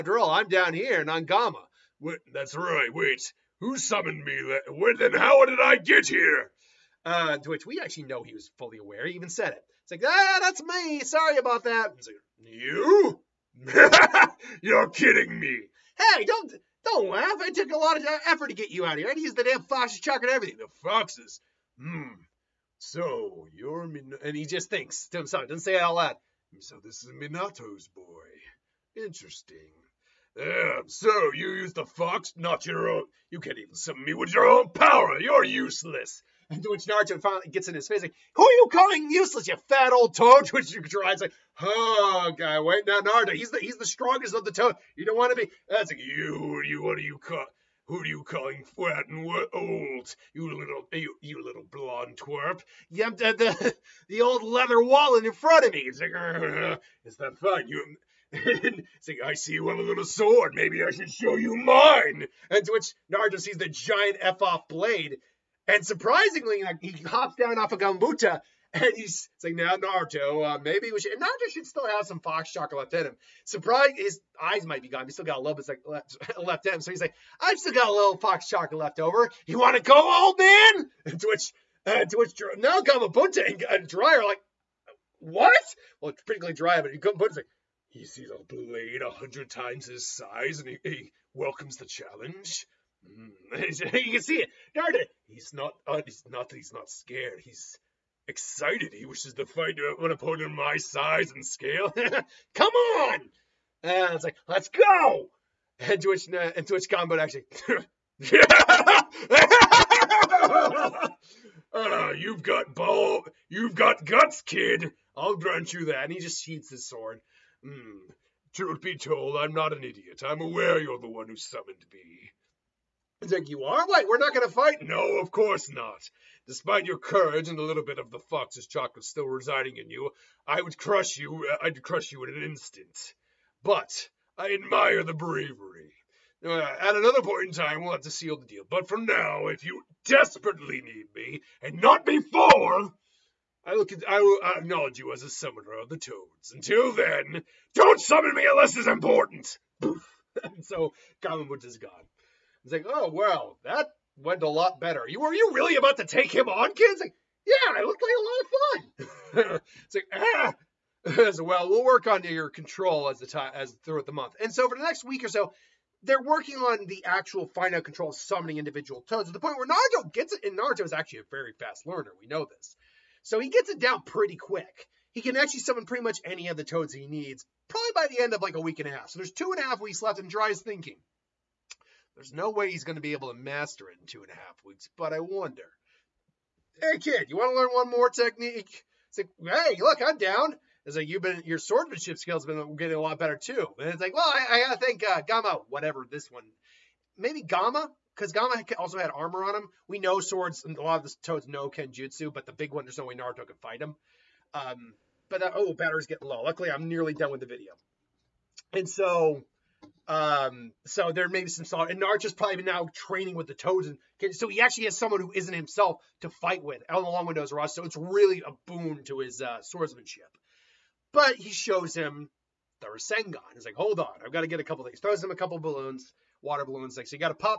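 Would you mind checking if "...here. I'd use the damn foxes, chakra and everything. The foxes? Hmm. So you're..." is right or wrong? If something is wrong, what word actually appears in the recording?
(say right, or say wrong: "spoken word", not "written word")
right.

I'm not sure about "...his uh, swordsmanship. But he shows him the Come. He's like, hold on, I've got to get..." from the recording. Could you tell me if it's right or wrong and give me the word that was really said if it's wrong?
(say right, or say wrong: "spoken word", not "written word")
wrong: "Rasengan", not "Come".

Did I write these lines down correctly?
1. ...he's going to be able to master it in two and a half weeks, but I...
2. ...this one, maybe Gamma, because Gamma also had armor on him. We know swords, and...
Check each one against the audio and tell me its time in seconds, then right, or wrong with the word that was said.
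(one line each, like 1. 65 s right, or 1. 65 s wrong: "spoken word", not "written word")
1. 182 s right
2. 196 s right.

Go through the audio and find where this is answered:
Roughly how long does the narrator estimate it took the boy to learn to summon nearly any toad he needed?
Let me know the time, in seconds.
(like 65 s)
178 s.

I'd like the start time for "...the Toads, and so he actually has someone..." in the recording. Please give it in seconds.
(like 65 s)
213 s.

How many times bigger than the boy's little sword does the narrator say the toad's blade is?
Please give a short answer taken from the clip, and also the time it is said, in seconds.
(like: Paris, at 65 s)
100, at 89 s.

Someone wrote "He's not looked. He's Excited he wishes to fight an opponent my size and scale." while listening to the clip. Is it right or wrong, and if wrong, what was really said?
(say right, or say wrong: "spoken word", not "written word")
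wrong: "scared", not "looked".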